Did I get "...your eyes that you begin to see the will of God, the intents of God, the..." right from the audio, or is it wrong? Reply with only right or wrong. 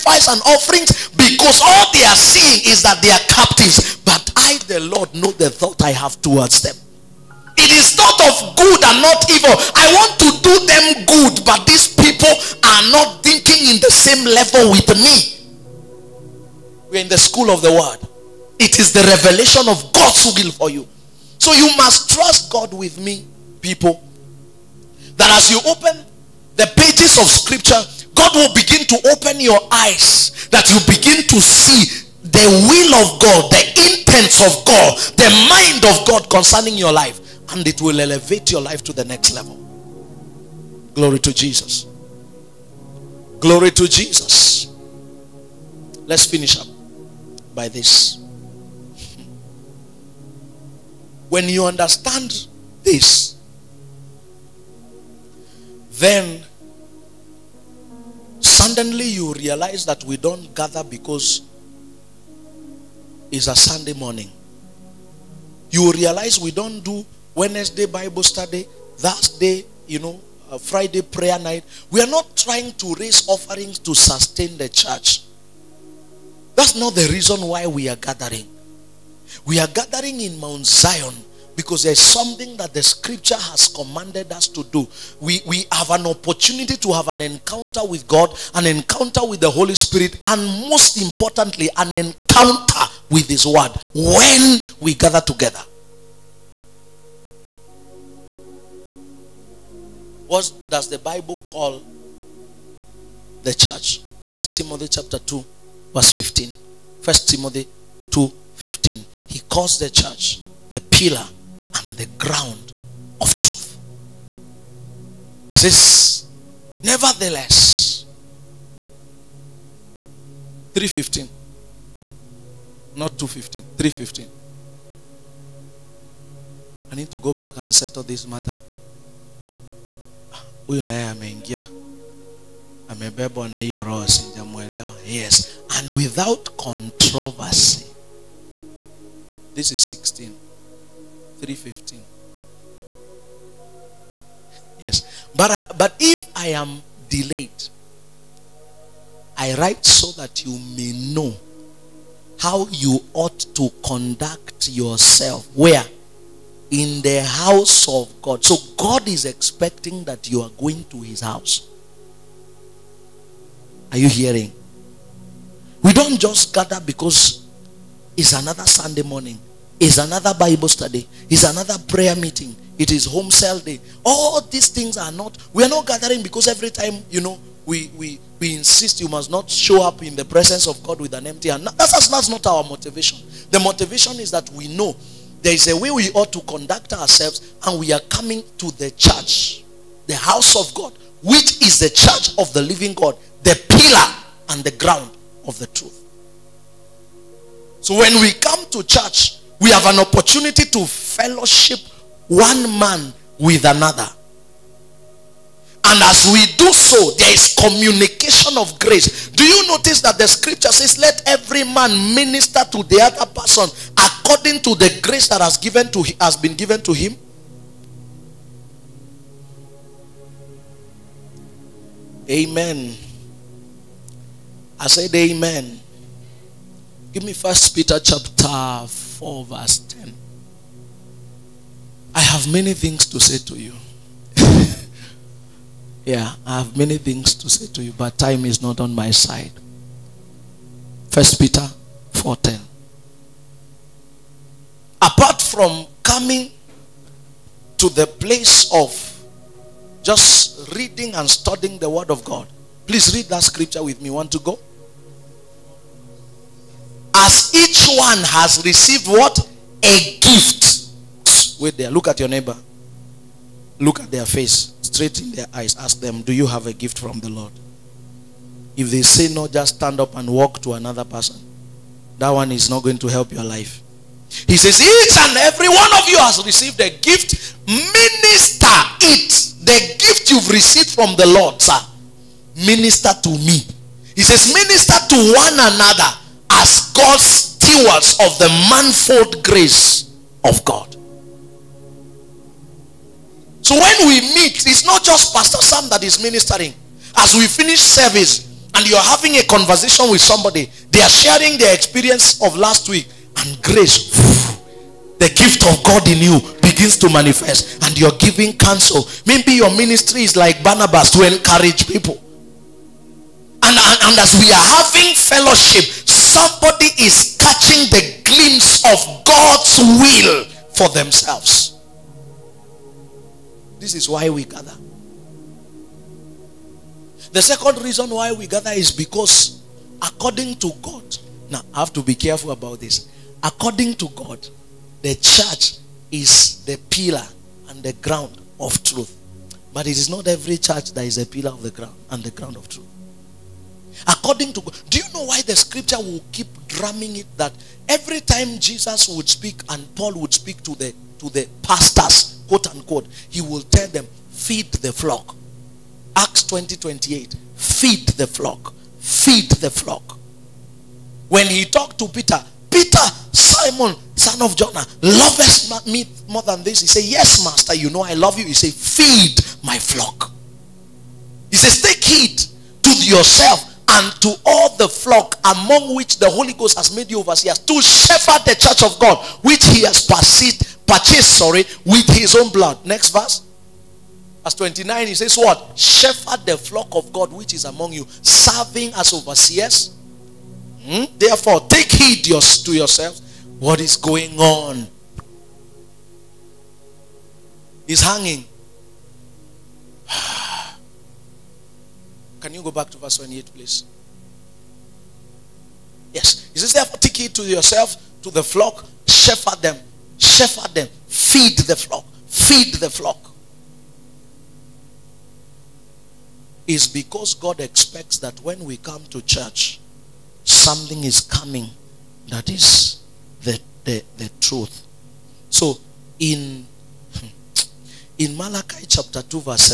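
right.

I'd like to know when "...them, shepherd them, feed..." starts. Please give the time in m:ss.
6:49.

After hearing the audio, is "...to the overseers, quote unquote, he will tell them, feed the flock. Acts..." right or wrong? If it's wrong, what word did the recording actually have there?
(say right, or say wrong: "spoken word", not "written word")
wrong: "pastors", not "overseers".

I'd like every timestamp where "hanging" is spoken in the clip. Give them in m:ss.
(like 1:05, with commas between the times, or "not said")
6:38.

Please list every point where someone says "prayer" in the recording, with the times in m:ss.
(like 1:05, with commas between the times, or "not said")
1:11, 2:51.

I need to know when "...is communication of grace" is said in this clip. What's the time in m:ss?
3:27.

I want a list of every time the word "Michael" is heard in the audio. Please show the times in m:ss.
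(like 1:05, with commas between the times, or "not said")
not said.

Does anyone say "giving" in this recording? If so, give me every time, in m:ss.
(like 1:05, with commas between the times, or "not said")
5:08.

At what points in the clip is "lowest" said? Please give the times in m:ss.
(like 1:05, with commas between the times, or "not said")
not said.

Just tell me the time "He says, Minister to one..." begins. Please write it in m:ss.
4:44.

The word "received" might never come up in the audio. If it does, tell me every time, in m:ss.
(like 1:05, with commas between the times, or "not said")
4:18, 4:36, 4:40.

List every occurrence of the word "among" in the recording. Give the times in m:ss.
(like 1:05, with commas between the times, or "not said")
6:15, 6:27.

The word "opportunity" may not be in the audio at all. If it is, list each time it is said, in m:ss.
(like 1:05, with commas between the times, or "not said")
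1:26, 3:19.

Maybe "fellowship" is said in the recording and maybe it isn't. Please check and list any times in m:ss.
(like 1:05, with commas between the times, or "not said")
3:20, 5:15.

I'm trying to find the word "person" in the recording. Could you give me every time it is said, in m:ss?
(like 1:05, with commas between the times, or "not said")
3:33, 4:31.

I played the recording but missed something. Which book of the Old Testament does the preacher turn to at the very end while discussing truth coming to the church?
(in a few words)
Malachi.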